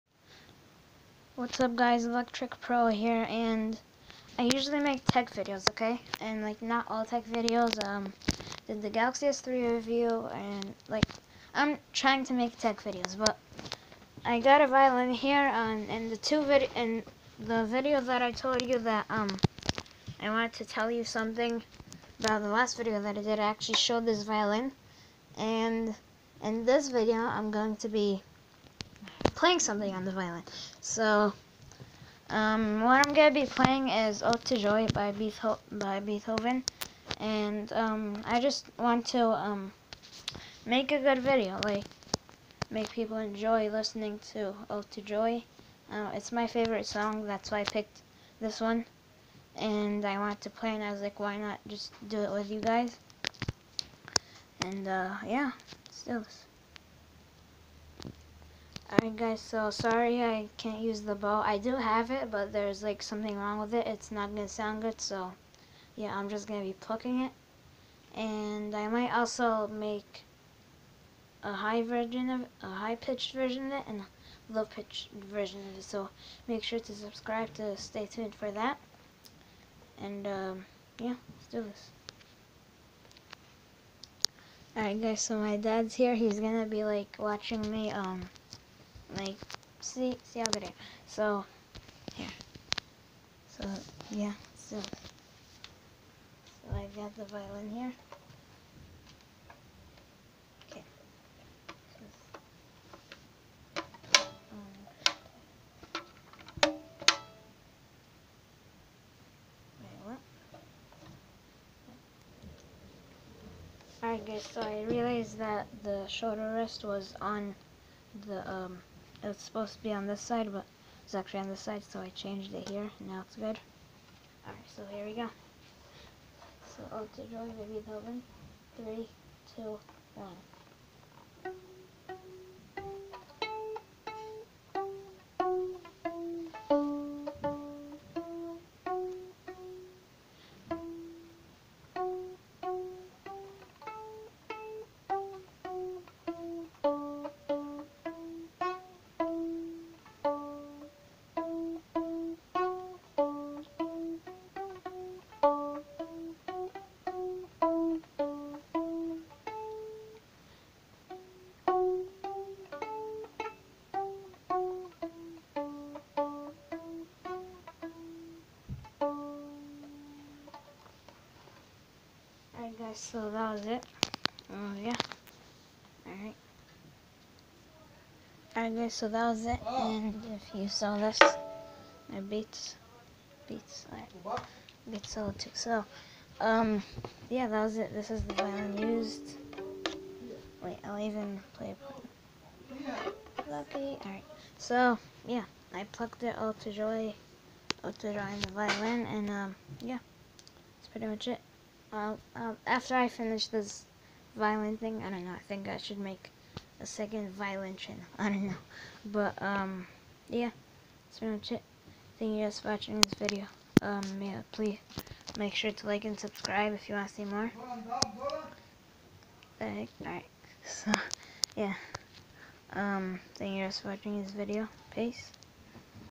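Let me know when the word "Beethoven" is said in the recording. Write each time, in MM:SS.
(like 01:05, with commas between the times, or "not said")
00:35, 02:07.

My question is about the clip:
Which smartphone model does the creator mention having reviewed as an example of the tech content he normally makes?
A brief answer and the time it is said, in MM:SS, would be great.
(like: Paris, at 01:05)
Galaxy S3, at 00:08.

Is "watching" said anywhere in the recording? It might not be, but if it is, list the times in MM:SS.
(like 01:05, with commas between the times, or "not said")
01:27, 03:32, 03:43.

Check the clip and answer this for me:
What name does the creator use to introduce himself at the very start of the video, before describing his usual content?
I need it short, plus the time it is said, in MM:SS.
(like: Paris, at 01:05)
Electric Pro, at 00:02.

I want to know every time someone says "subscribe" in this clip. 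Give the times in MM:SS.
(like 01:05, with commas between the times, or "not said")
01:16, 03:36.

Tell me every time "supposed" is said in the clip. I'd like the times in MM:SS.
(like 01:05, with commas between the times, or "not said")
01:59.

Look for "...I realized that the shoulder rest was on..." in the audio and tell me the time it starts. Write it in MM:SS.
01:54.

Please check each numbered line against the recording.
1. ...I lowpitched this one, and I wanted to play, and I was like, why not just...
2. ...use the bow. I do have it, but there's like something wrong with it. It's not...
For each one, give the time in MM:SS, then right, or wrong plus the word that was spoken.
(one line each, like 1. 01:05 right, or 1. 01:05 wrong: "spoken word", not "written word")
1. 00:47 wrong: "picked", not "lowpitched"
2. 01:00 right.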